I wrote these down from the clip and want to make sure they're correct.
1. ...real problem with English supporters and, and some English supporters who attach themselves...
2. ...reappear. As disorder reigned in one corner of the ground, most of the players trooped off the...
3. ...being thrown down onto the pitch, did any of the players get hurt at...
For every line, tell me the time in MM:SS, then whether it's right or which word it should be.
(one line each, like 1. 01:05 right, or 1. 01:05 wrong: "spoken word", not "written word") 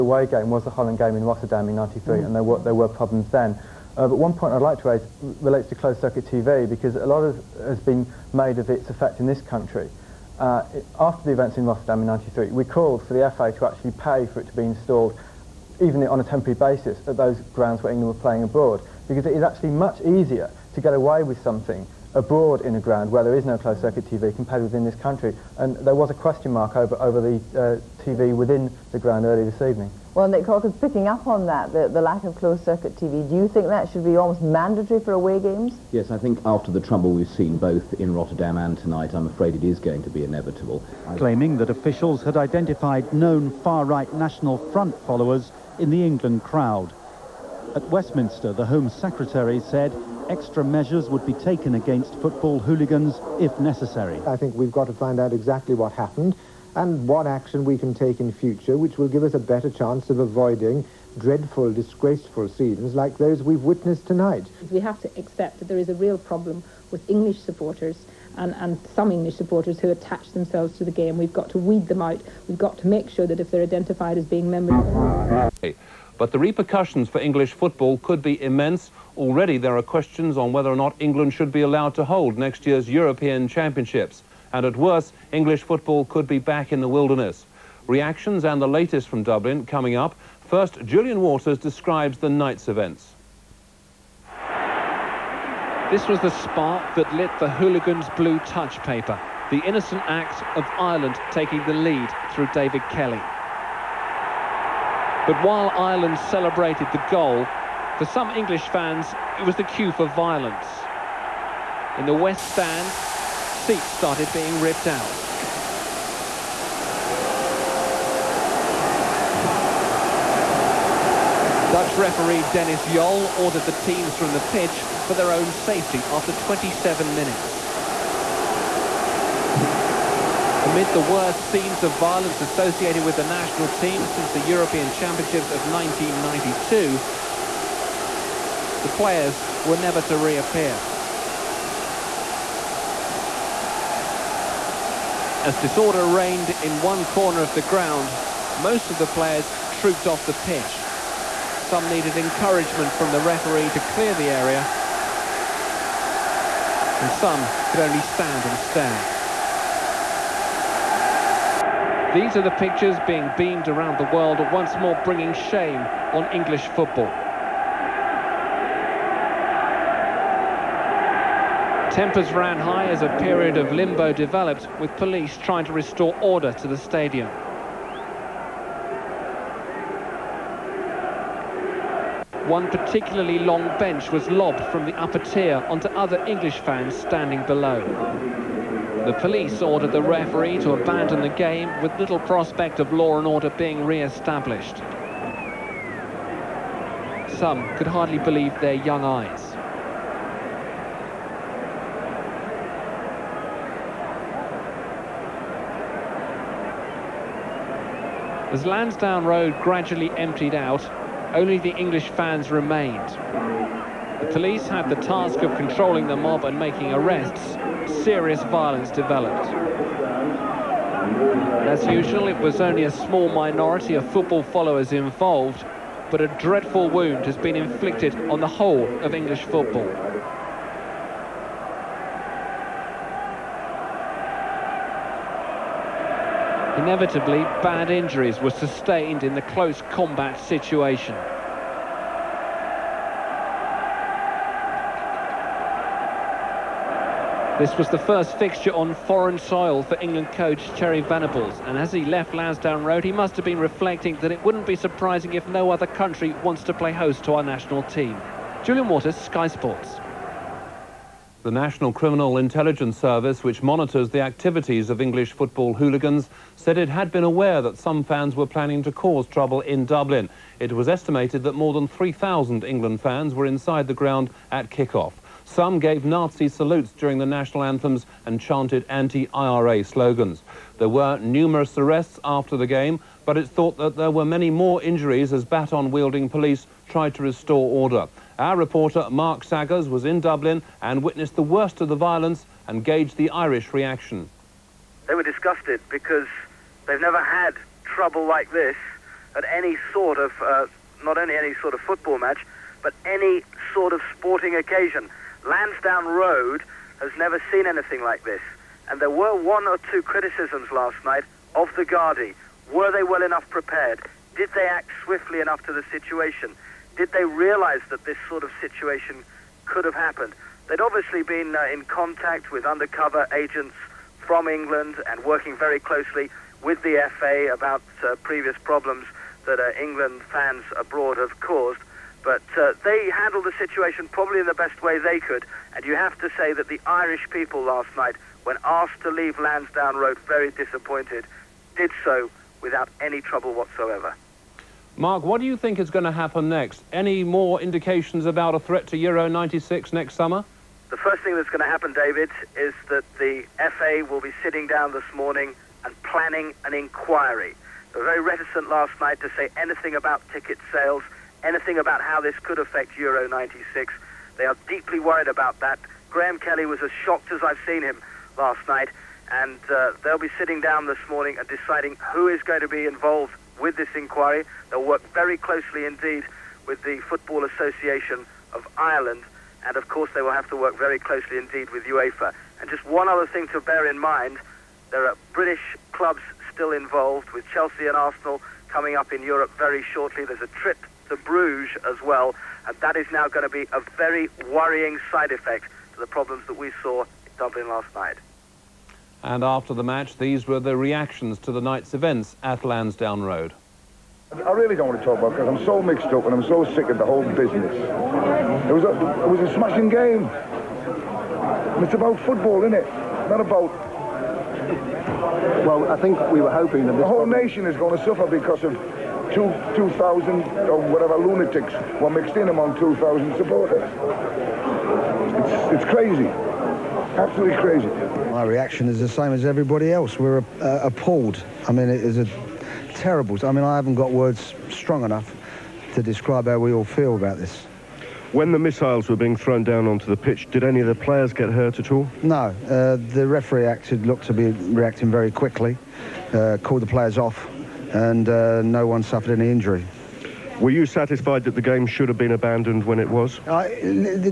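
1. 01:05 right
2. 02:20 right
3. 07:19 right.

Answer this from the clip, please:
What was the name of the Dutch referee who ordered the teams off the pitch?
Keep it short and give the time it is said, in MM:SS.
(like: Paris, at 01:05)
Dennis Jol, at 02:02.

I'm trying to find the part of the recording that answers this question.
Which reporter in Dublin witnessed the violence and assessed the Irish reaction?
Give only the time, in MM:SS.
04:49.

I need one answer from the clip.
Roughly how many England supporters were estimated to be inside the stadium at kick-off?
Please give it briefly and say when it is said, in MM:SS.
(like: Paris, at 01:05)
More than 3,000, at 04:31.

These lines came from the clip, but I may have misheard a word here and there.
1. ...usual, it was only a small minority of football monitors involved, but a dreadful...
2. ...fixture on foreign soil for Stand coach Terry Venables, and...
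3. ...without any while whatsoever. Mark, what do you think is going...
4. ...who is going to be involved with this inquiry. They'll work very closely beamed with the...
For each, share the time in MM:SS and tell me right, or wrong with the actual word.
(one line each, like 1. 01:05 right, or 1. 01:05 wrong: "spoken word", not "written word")
1. 03:41 wrong: "followers", not "monitors"
2. 04:08 wrong: "England", not "Stand"
3. 05:42 wrong: "trouble", not "while"
4. 06:12 wrong: "indeed", not "beamed".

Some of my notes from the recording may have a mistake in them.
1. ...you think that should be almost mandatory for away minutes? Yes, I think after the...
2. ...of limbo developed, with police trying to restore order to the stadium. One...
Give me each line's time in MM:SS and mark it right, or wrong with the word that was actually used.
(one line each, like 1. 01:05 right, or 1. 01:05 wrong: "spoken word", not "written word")
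1. 00:33 wrong: "games", not "minutes"
2. 02:53 right.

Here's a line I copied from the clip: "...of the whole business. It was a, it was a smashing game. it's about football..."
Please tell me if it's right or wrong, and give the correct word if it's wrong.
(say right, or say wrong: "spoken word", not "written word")
right.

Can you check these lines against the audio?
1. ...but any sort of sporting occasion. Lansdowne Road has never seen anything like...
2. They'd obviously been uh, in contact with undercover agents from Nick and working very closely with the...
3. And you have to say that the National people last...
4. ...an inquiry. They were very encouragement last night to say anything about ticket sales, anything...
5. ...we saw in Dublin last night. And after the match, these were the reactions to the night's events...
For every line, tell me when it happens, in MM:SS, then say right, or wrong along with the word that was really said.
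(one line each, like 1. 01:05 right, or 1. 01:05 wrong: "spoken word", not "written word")
1. 05:02 right
2. 05:20 wrong: "England", not "Nick"
3. 05:35 wrong: "Irish", not "National"
4. 05:56 wrong: "reticent", not "encouragement"
5. 06:36 right.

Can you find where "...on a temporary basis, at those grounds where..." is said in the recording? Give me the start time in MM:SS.
00:16.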